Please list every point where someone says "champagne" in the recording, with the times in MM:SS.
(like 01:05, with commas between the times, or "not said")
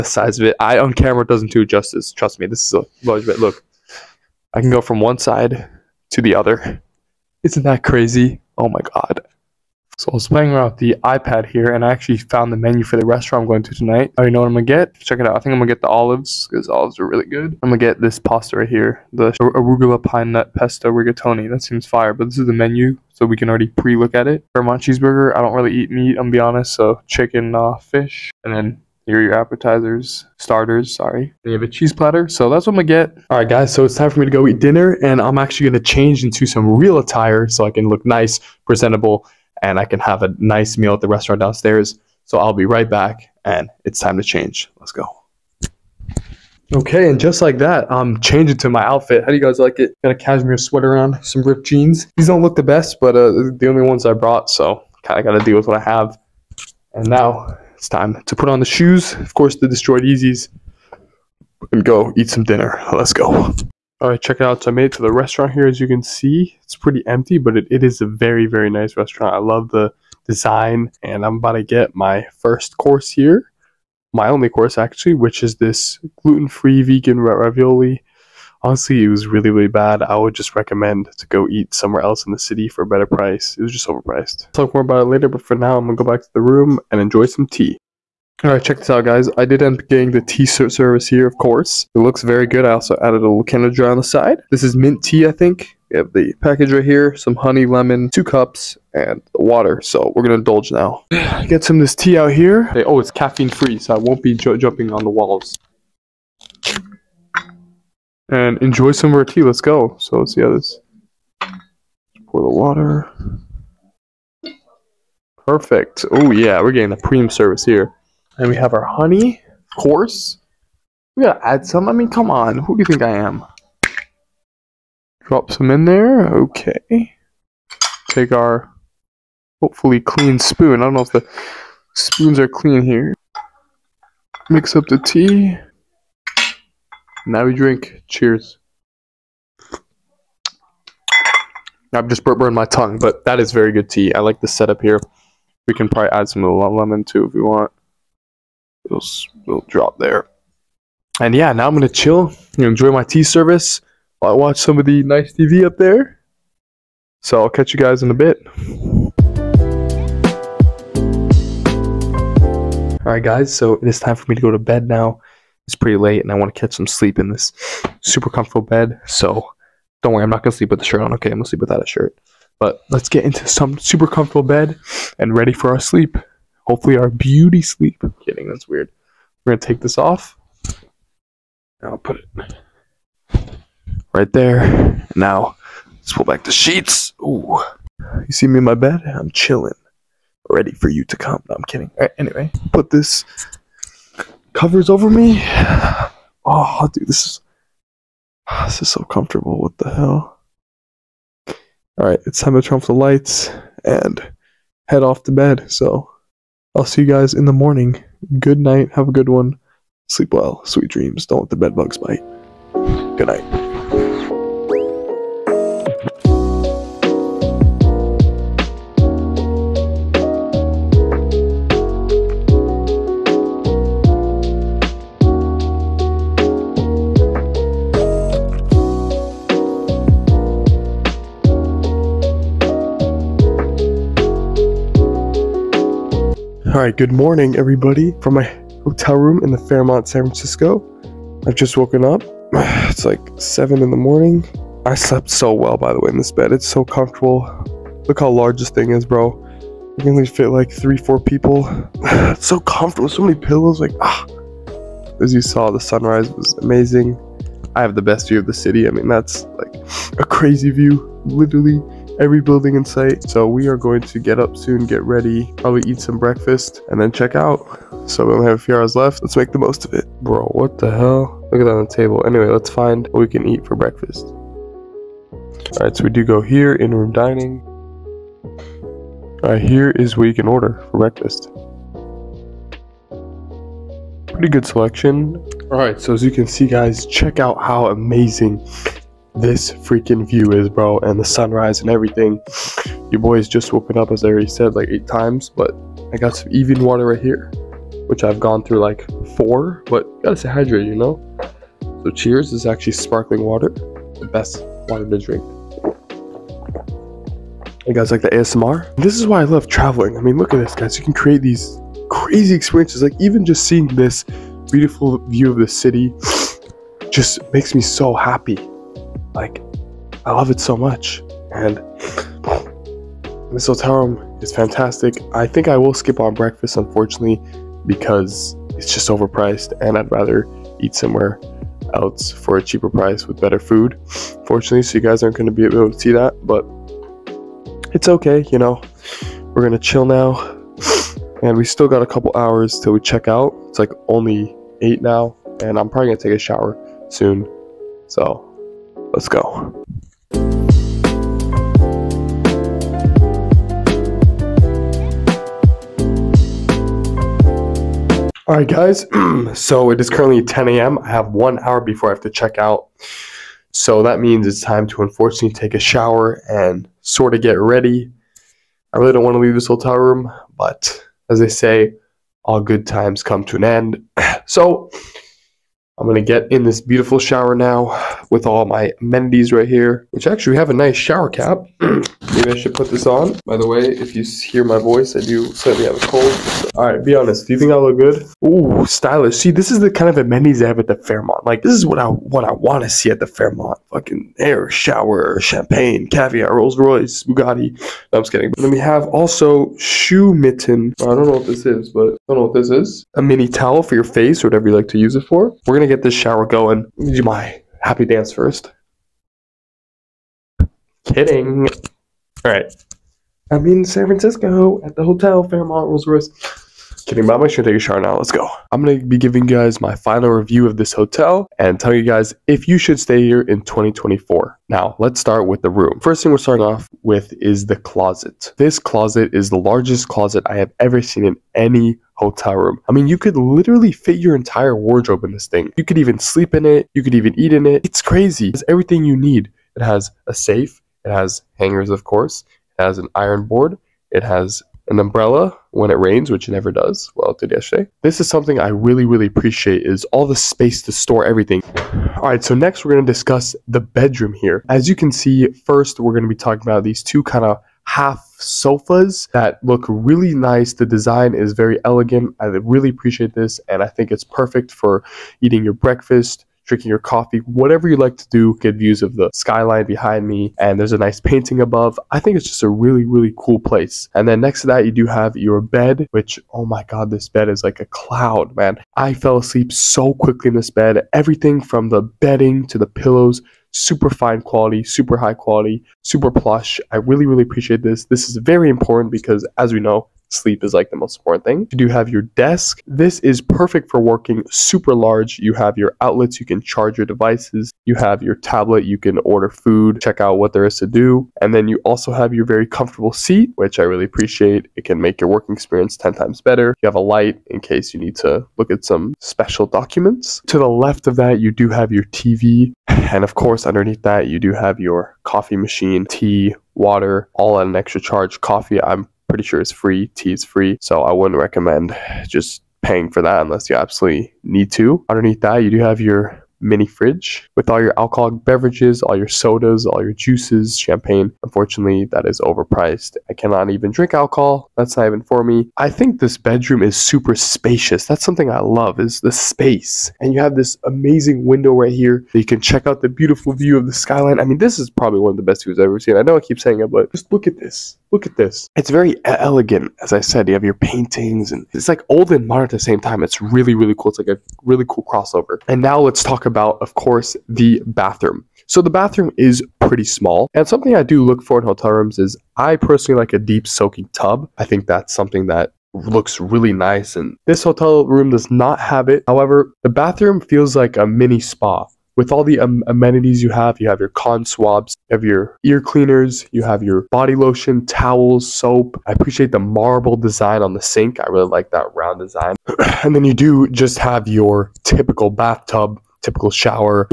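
06:35, 08:50.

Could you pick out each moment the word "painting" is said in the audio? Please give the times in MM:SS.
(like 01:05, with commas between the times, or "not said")
07:51, 09:10.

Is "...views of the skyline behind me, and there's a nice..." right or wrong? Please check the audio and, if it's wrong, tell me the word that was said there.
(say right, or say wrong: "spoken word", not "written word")
right.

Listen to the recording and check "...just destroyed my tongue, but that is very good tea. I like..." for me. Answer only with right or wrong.
wrong.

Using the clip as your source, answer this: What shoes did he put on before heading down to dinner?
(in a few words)
destroyed Yeezys.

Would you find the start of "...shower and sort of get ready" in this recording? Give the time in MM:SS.
06:05.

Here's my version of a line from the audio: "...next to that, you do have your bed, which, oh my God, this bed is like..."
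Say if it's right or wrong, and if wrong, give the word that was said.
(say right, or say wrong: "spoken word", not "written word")
right.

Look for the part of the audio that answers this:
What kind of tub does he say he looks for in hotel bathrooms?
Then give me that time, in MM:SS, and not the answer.
09:23.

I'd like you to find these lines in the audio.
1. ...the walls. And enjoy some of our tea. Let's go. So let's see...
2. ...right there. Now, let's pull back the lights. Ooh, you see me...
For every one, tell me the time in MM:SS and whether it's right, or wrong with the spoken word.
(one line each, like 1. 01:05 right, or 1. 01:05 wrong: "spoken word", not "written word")
1. 01:45 right
2. 03:04 wrong: "sheets", not "lights".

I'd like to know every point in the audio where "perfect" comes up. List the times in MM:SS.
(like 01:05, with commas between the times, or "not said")
01:55, 07:44, 08:13.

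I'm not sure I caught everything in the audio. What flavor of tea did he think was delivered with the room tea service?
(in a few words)
mint.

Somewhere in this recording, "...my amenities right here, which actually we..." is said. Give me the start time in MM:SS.
06:18.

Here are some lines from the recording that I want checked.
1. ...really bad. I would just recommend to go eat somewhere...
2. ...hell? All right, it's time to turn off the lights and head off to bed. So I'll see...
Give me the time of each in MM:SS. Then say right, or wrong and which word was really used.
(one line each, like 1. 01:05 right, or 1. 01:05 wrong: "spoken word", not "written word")
1. 01:19 right
2. 03:19 right.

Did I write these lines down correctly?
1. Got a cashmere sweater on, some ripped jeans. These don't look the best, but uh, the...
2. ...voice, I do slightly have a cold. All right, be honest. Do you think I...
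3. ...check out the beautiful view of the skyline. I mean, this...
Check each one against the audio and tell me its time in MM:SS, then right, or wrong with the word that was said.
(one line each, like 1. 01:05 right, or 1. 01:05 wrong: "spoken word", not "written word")
1. 00:50 right
2. 06:24 right
3. 09:02 right.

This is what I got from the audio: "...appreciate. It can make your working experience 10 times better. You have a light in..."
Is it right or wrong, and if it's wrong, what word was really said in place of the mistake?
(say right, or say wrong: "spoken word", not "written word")
right.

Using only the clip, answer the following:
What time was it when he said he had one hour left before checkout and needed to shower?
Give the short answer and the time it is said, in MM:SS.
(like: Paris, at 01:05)
10 a.m., at 06:00.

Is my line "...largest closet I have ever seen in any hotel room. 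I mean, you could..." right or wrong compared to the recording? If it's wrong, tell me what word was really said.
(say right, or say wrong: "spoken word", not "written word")
right.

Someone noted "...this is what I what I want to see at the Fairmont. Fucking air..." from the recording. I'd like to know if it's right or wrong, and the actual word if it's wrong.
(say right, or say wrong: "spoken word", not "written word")
right.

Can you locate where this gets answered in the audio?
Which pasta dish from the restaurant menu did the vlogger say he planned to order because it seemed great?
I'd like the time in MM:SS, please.
00:19.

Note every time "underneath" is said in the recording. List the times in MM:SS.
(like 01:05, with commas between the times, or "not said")
08:33, 08:45.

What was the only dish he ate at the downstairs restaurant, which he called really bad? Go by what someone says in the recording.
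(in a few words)
gluten-free vegan ravioli.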